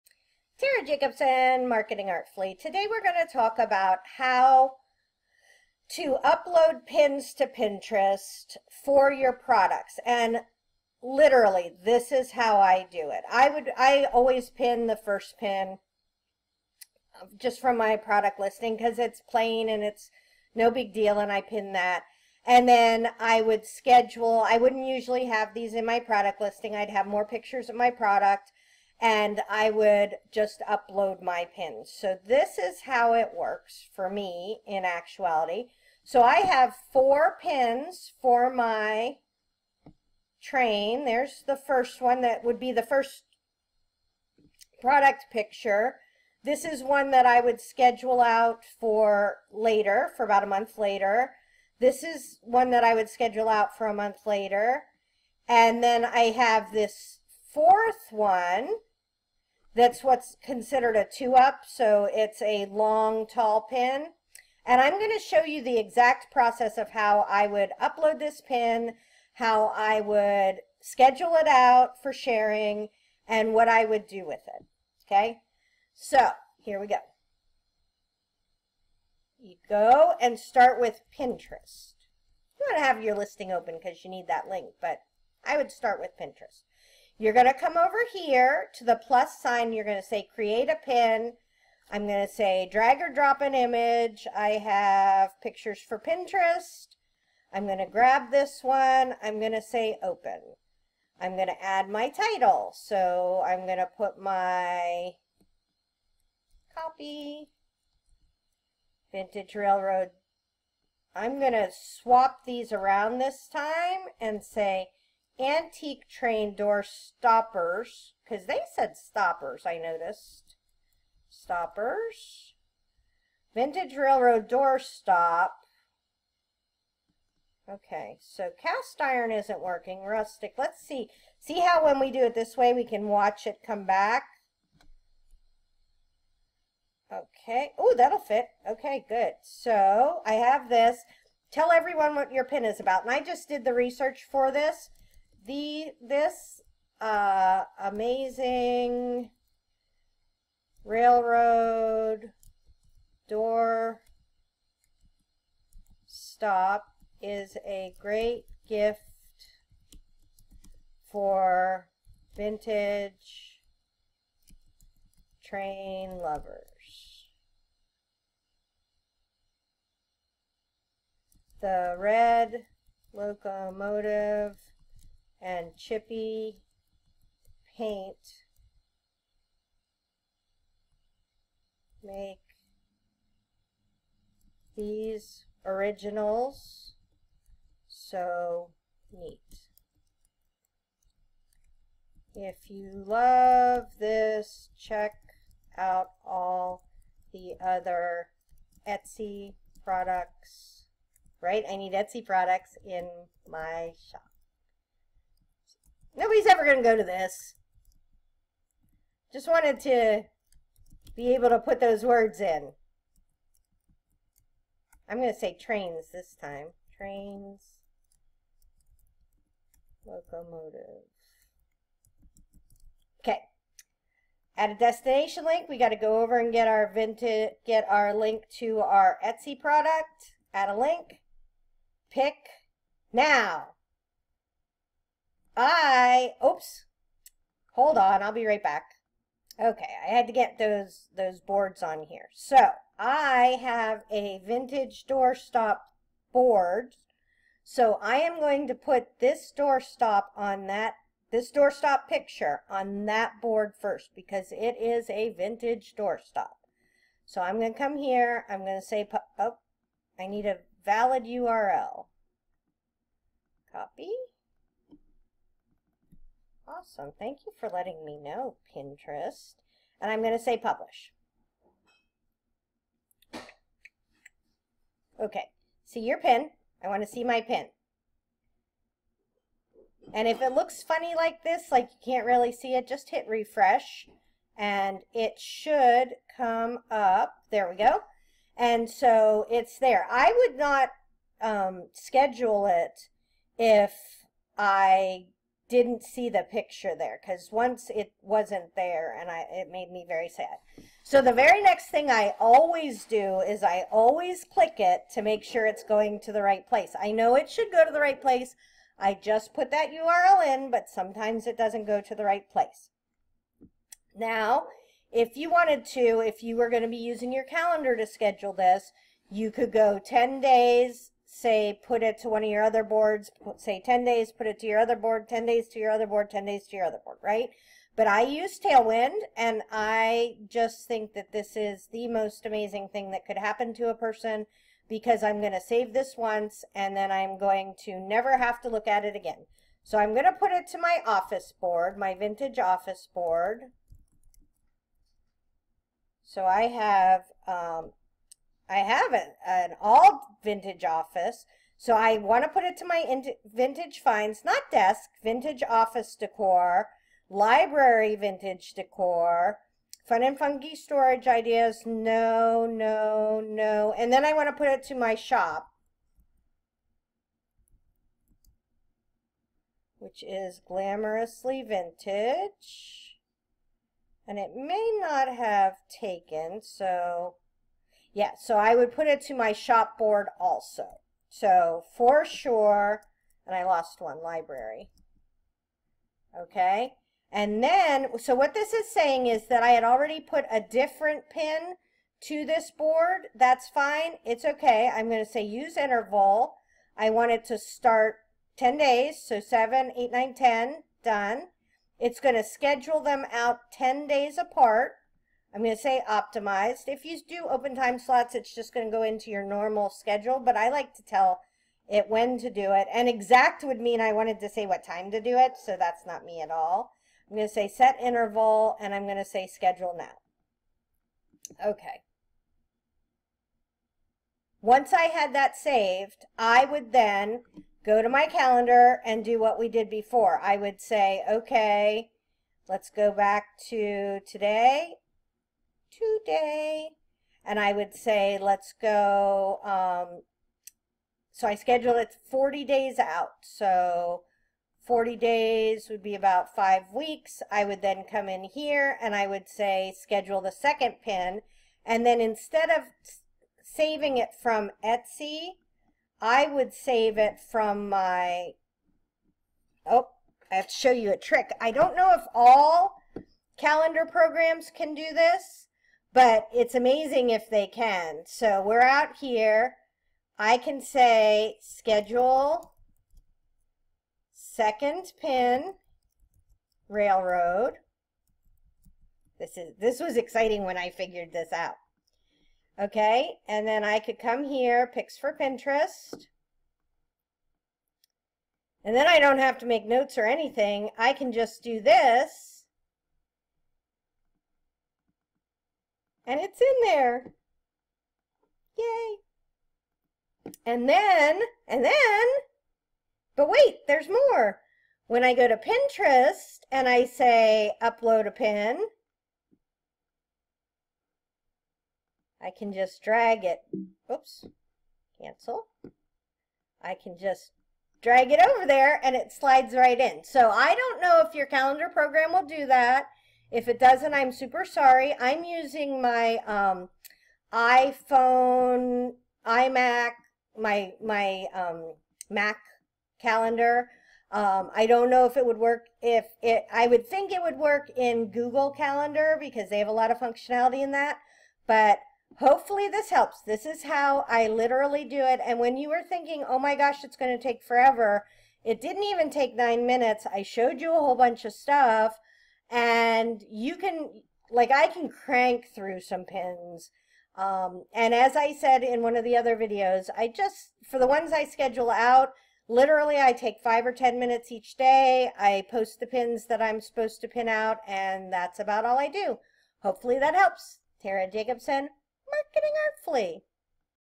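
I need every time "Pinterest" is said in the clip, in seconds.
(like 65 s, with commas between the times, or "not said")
7 s, 81 s, 86 s, 95 s, 268 s, 485 s, 505 s.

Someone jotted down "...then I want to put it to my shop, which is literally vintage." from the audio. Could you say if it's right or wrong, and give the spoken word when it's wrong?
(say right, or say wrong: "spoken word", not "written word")
wrong: "glamorously", not "literally".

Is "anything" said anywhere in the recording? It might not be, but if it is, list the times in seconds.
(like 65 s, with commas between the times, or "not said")
490 s.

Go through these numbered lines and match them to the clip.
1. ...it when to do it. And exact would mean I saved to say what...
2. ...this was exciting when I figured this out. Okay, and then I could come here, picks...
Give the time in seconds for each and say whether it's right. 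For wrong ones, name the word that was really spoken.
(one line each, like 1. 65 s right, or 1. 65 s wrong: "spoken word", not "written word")
1. 411 s wrong: "wanted", not "saved"
2. 479 s right.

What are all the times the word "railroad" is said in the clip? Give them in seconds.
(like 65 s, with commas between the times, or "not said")
109 s, 123 s, 150 s, 476 s.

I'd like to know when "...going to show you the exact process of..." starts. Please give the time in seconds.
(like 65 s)
64 s.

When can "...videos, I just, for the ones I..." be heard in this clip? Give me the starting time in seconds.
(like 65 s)
559 s.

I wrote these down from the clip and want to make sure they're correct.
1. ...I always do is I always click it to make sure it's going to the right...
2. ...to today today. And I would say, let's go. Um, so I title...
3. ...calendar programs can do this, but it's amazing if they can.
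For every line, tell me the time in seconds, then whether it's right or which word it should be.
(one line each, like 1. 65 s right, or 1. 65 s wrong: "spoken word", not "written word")
1. 302 s right
2. 433 s wrong: "schedule", not "title"
3. 463 s right.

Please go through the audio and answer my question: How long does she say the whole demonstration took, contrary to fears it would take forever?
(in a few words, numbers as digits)
under 9 minutes.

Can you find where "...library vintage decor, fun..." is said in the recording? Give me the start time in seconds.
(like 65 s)
357 s.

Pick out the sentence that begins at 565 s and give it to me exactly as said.
I post the pins that I'm supposed to pin out, and that's about all I do.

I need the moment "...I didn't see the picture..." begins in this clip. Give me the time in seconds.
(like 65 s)
294 s.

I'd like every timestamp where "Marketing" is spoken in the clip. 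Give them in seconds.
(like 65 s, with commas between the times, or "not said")
1 s, 572 s.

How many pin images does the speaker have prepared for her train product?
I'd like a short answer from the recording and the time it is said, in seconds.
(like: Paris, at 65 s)
4, at 36 s.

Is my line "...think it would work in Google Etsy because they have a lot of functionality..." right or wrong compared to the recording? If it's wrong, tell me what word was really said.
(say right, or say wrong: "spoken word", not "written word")
wrong: "Calendar", not "Etsy".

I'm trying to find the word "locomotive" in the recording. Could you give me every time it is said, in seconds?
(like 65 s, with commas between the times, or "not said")
173 s, 220 s.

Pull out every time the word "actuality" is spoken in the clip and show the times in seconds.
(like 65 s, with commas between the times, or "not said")
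34 s.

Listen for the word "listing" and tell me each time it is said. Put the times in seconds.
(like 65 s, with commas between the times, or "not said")
18 s, 26 s, 83 s.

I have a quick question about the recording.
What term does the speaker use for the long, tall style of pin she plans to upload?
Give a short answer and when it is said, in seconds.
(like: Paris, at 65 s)
a two-up, at 60 s.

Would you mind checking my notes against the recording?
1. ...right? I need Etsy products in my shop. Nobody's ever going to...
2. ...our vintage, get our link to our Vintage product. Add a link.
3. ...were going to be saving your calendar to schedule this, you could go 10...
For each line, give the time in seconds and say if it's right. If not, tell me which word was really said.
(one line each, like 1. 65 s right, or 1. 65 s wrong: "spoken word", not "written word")
1. 201 s right
2. 226 s wrong: "Etsy", not "Vintage"
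3. 316 s wrong: "using", not "saving".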